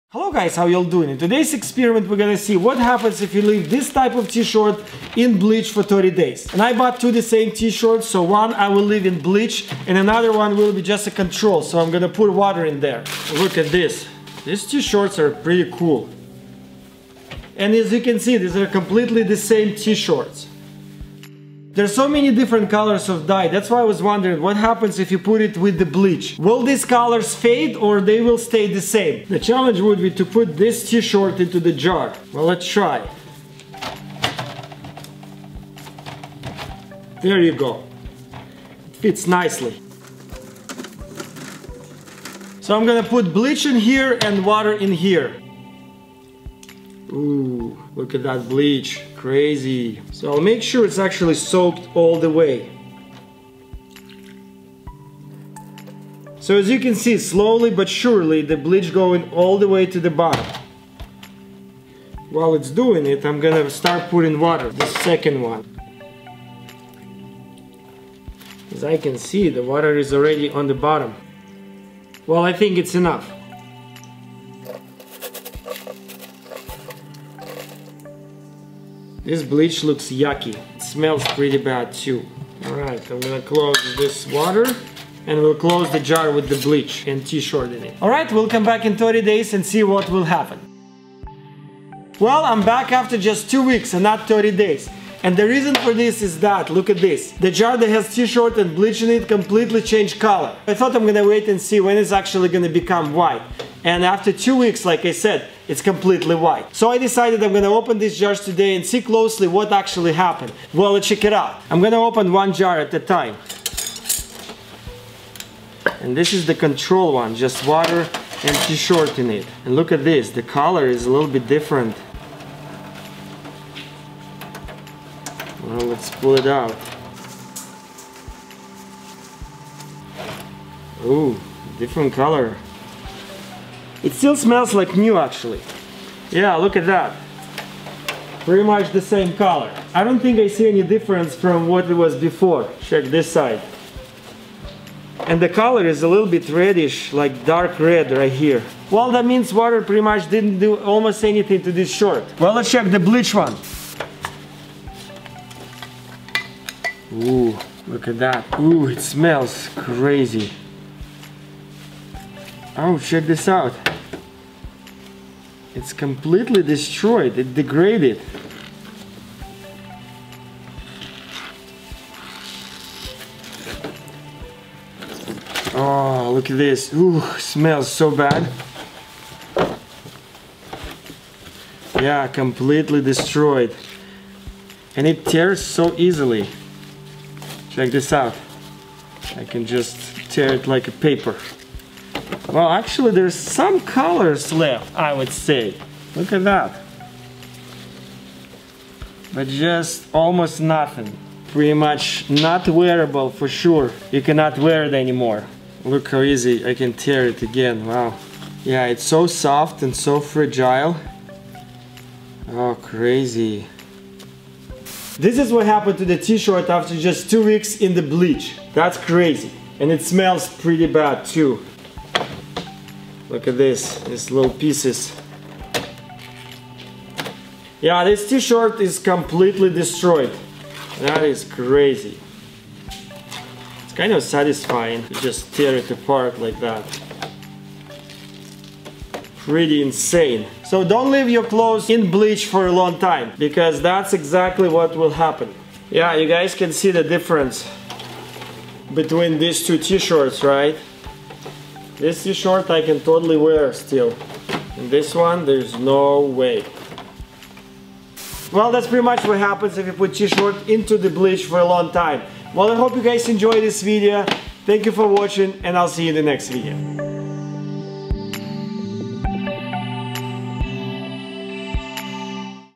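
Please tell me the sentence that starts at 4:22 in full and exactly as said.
Well, I hope you guys enjoyed this video.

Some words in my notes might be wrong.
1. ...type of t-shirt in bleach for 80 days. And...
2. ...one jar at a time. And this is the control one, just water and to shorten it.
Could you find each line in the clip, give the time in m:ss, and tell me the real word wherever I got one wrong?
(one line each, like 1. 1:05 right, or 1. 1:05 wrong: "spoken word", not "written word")
1. 0:03 wrong: "30", not "80"
2. 1:52 right.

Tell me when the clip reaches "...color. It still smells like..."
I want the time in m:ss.
2:12.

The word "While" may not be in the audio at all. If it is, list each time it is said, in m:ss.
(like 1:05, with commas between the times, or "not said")
1:02.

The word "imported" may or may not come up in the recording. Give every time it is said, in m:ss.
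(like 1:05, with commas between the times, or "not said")
not said.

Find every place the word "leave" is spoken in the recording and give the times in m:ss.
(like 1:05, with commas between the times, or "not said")
0:03, 0:08, 4:01.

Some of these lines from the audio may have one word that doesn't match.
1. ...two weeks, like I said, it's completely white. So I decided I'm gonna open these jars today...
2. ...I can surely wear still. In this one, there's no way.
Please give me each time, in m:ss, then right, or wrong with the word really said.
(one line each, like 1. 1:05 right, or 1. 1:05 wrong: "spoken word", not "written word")
1. 1:44 right
2. 4:12 wrong: "totally", not "surely".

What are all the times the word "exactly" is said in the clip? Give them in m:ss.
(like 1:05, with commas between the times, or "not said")
4:04.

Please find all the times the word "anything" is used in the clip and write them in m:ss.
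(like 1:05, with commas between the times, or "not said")
2:31.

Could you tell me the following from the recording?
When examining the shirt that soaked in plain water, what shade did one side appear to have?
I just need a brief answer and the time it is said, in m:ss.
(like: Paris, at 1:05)
dark red, at 2:27.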